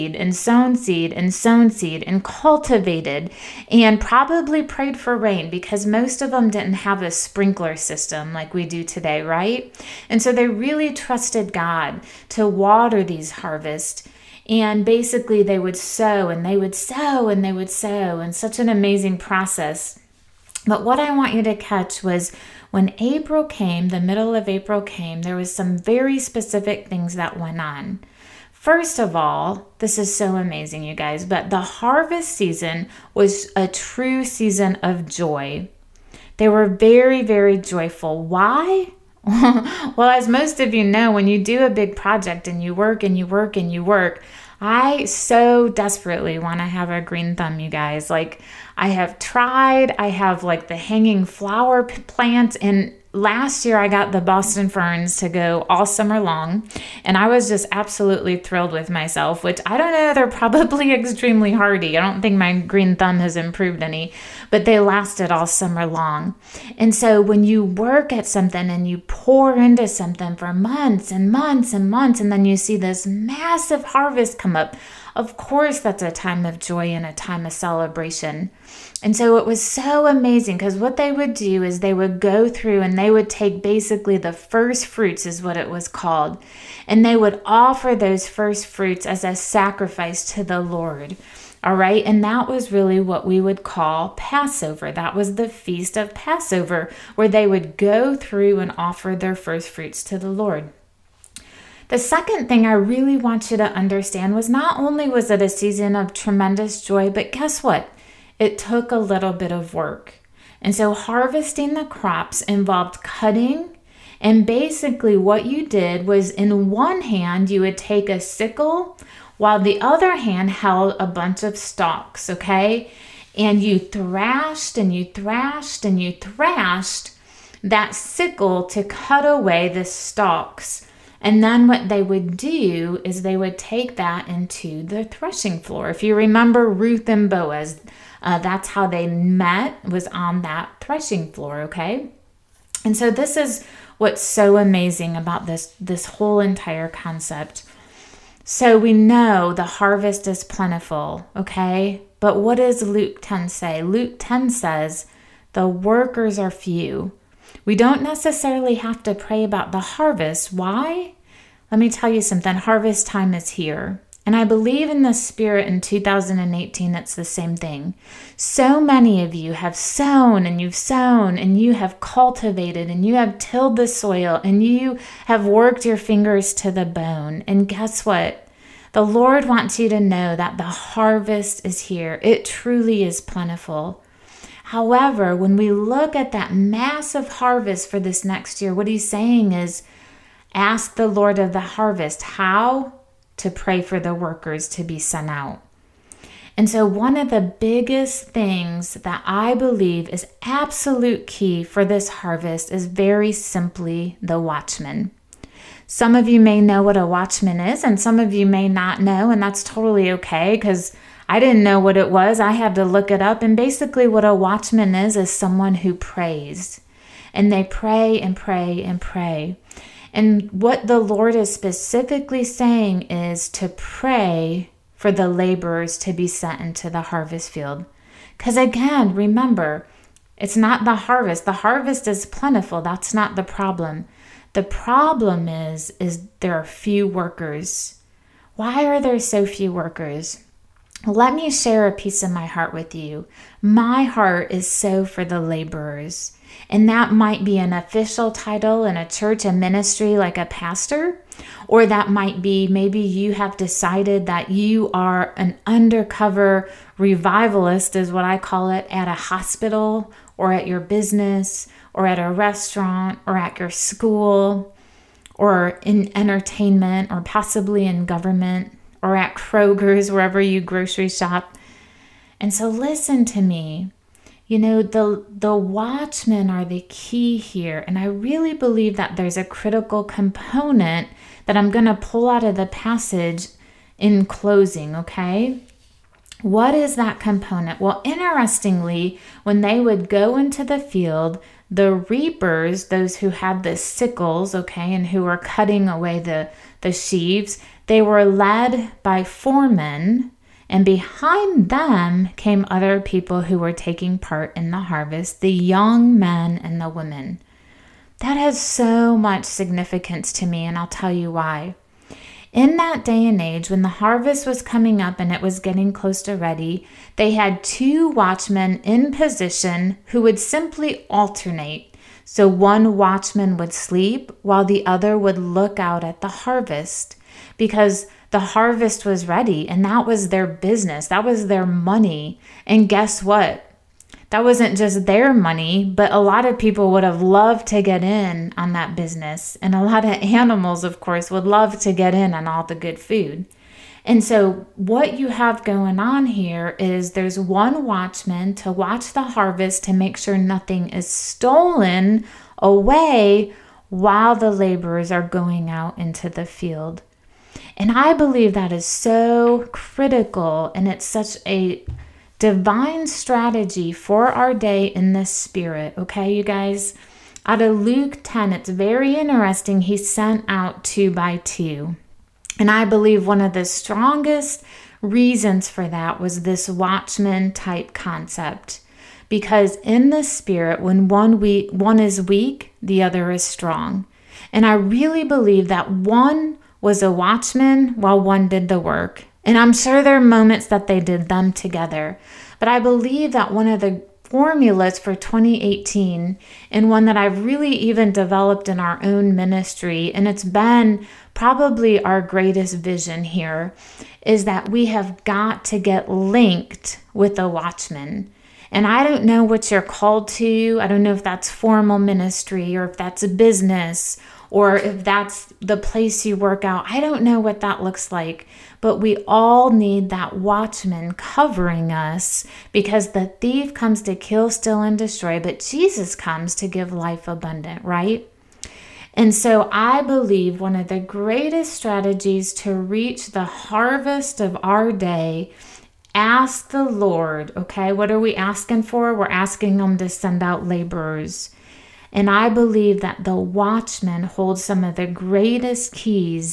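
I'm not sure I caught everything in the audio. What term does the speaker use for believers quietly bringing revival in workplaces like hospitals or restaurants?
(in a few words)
undercover revivalist.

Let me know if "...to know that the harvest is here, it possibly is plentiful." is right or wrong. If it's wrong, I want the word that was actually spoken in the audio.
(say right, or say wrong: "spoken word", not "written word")
wrong: "truly", not "possibly".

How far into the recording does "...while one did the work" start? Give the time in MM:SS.
06:27.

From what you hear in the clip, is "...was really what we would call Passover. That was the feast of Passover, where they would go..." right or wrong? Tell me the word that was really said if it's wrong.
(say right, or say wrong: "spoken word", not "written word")
right.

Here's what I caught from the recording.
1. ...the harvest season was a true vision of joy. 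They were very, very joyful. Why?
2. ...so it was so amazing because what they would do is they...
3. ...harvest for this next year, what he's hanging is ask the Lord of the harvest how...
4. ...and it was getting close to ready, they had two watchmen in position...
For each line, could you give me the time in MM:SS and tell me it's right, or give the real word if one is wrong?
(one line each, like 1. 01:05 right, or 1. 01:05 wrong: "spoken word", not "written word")
1. 00:31 wrong: "season", not "vision"
2. 01:19 right
3. 03:07 wrong: "saying", not "hanging"
4. 05:15 right.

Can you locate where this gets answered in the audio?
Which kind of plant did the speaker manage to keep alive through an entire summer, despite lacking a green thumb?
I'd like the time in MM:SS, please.
00:54.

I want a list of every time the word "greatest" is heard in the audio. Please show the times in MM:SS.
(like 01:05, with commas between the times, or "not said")
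06:42, 07:10, 07:25.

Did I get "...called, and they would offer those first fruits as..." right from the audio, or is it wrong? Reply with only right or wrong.
right.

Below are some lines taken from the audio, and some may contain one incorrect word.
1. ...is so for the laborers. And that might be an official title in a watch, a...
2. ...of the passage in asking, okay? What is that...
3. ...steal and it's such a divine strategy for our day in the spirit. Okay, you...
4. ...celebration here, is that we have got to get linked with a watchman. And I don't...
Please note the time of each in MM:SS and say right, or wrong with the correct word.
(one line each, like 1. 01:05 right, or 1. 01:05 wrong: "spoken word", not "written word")
1. 04:04 wrong: "church", not "watch"
2. 04:42 wrong: "closing", not "asking"
3. 05:59 wrong: "critical", not "steal"
4. 06:42 wrong: "vision", not "celebration".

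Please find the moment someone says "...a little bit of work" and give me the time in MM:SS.
01:48.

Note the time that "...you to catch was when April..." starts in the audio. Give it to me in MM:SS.
00:21.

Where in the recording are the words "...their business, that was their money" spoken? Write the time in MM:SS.
05:30.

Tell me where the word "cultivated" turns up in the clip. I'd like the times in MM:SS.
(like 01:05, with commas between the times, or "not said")
00:02, 02:52.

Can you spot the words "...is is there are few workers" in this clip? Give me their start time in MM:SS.
03:55.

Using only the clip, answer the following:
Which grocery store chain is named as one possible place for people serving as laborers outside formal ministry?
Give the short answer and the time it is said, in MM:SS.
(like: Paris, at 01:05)
Kroger's, at 04:29.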